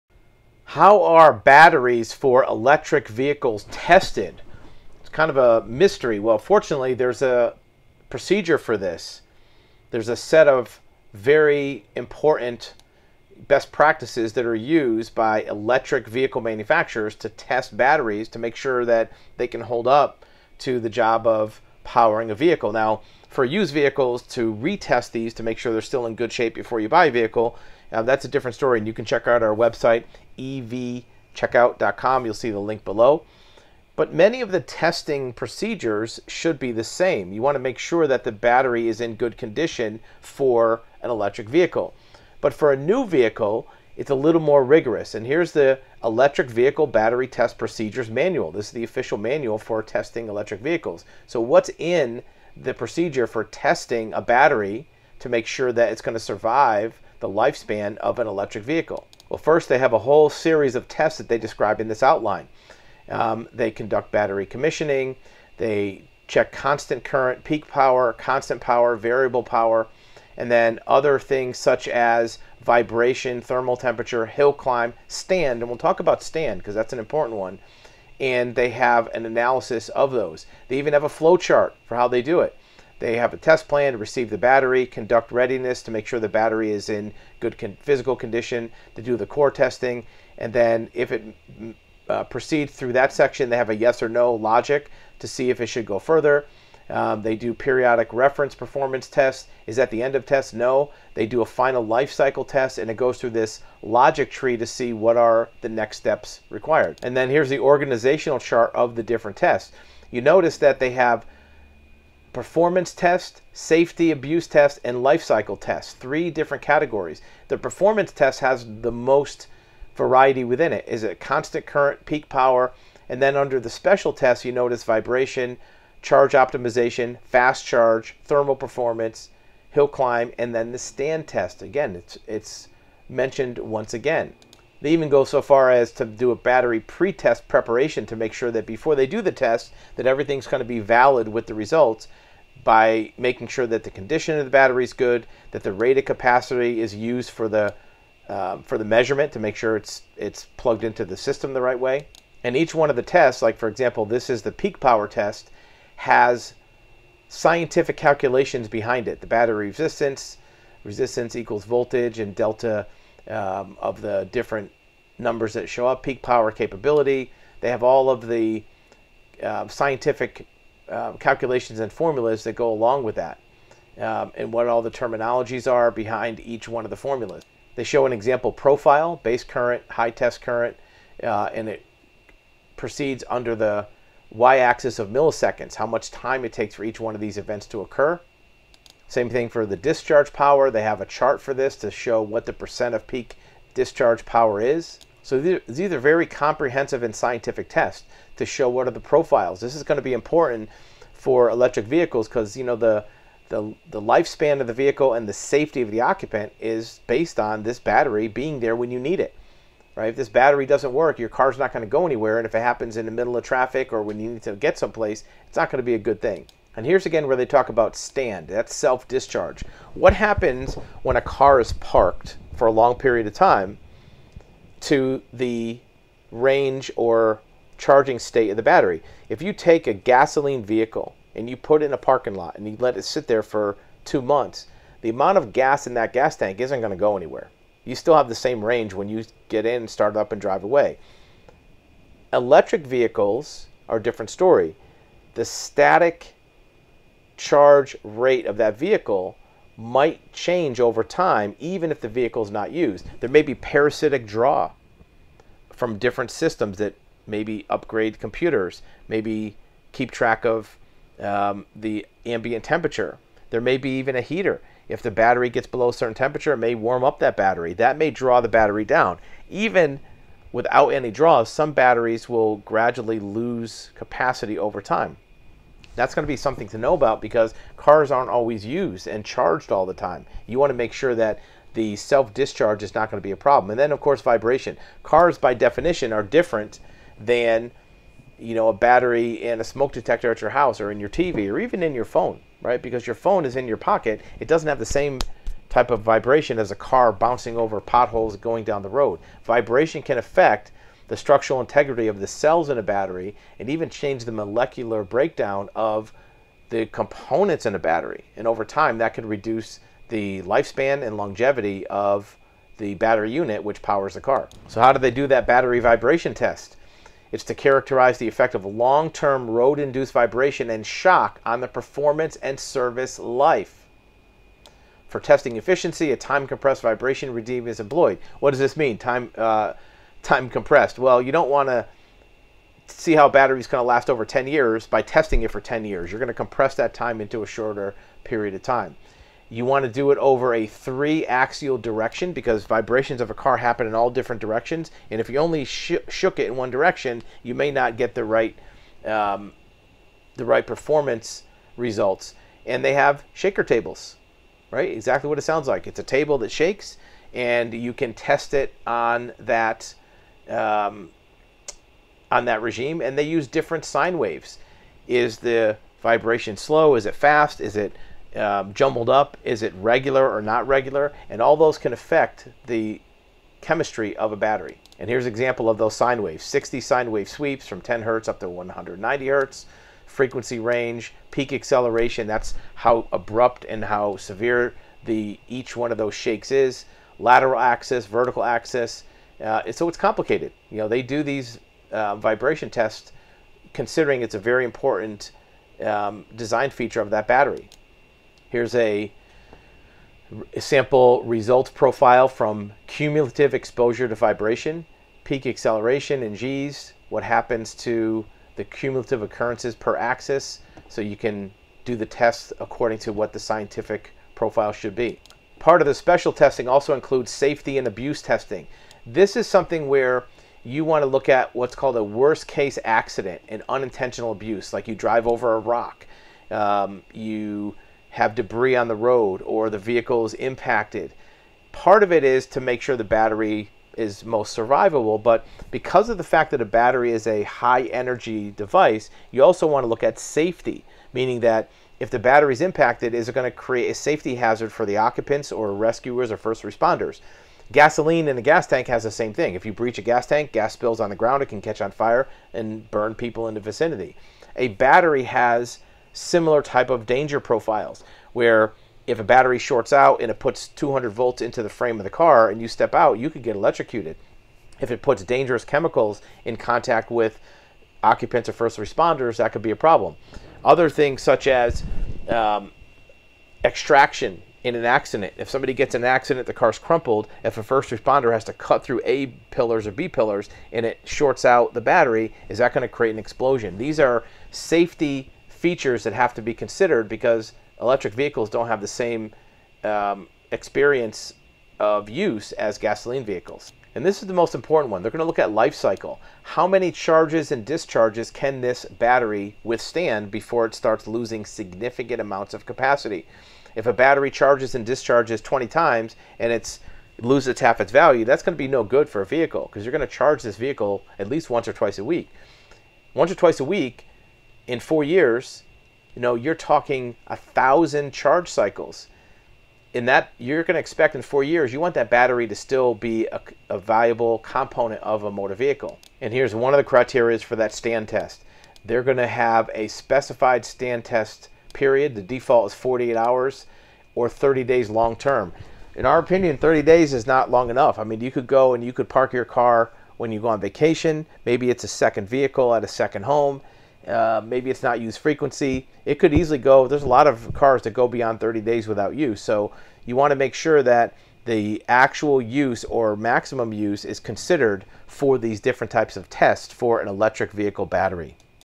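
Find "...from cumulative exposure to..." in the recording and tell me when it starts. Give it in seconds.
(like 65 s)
402 s.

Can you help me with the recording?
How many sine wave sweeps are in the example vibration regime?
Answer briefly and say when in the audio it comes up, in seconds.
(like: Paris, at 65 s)
60, at 376 s.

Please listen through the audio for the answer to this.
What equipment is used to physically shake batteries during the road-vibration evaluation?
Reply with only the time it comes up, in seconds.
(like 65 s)
353 s.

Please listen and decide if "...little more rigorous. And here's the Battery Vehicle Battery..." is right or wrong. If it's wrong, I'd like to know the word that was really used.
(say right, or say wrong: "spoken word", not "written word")
wrong: "Electric", not "Battery".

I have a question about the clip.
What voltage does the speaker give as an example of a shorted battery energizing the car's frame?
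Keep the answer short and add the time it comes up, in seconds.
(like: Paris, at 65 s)
200 volts, at 460 s.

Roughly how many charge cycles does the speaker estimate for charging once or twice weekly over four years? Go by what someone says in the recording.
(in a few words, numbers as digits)
1000.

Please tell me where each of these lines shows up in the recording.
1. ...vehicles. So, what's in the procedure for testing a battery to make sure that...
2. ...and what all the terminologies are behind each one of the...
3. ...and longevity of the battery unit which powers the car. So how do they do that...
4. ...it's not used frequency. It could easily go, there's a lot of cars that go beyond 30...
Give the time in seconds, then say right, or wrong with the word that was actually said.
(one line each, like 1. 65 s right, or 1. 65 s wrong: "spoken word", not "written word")
1. 50 s right
2. 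174 s right
3. 311 s right
4. 544 s right.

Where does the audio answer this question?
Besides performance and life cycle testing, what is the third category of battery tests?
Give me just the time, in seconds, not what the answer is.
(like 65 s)
113 s.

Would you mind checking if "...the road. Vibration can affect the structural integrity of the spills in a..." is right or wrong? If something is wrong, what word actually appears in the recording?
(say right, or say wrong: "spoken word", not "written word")
wrong: "cells", not "spills".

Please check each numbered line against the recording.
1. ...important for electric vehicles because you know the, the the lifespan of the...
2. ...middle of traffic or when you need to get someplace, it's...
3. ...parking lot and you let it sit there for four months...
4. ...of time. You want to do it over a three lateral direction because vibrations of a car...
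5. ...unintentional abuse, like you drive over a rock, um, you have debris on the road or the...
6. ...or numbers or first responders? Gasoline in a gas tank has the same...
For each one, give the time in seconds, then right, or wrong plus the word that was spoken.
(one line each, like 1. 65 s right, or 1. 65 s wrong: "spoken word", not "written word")
1. 200 s right
2. 213 s right
3. 231 s wrong: "two", not "four"
4. 338 s wrong: "axial", not "lateral"
5. 423 s right
6. 445 s wrong: "rescuers", not "numbers".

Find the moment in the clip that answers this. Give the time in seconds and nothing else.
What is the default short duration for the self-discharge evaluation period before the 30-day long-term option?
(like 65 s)
532 s.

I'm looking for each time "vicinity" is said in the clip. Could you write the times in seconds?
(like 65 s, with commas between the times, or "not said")
453 s.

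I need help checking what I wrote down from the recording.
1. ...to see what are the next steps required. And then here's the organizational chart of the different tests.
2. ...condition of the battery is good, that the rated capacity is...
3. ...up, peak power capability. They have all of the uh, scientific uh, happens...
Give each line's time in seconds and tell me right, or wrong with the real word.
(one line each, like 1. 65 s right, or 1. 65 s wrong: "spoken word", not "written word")
1. 104 s right
2. 143 s right
3. 165 s wrong: "calculations", not "happens".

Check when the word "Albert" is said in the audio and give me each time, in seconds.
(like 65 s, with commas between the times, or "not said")
not said.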